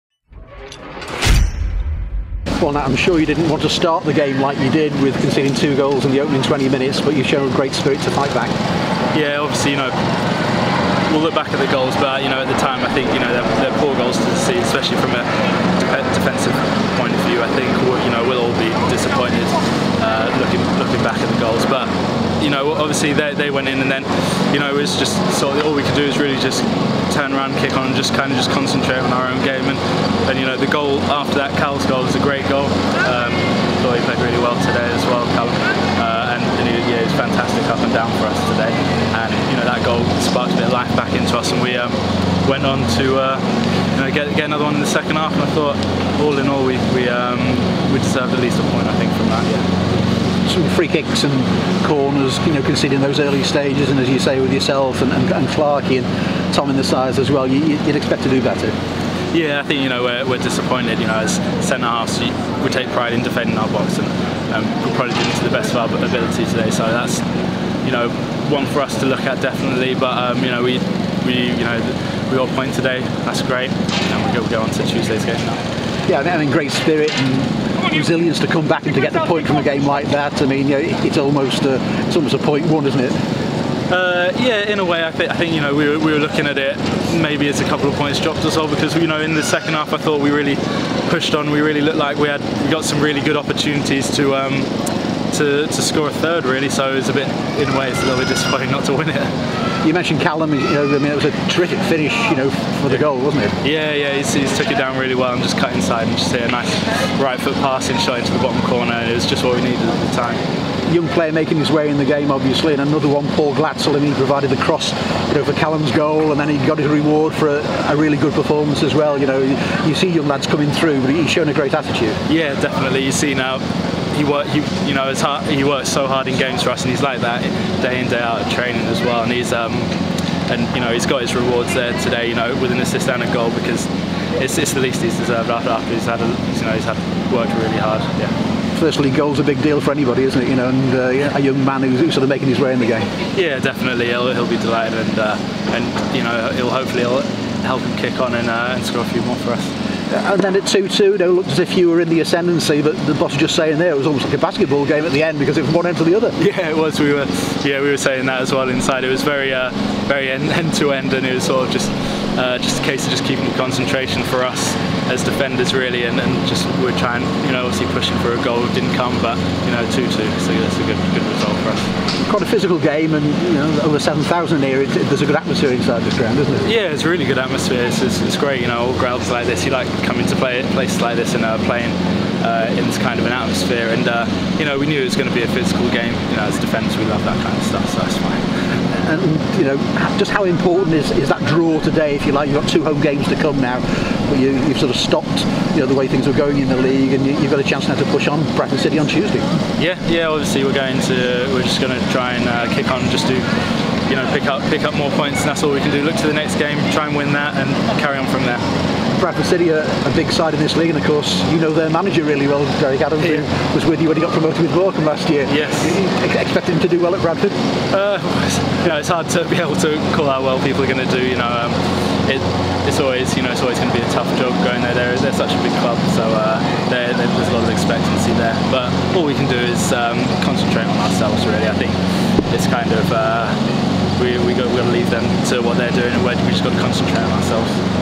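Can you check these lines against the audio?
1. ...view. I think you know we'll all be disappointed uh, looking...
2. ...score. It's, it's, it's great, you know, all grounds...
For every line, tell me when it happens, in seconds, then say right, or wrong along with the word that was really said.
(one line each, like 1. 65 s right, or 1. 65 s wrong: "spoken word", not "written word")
1. 17 s right
2. 177 s wrong: "atmosphere", not "score".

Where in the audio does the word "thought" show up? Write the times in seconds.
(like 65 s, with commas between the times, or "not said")
33 s, 45 s, 89 s.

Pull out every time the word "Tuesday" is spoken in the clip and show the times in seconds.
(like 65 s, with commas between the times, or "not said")
74 s, 199 s.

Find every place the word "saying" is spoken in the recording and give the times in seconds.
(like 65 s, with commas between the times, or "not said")
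153 s, 157 s.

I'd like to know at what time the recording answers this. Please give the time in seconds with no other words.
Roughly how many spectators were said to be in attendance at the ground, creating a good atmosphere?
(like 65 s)
173 s.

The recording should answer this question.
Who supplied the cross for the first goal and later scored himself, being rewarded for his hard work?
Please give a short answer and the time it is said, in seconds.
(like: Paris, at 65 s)
Paul Glatzel, at 113 s.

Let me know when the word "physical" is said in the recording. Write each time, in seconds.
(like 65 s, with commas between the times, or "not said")
172 s, 185 s.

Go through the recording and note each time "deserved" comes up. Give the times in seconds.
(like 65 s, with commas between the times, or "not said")
48 s, 135 s.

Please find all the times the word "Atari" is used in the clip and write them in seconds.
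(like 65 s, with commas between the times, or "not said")
not said.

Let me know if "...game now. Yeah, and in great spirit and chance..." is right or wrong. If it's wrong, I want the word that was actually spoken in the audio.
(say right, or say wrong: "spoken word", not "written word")
wrong: "resilience", not "chance".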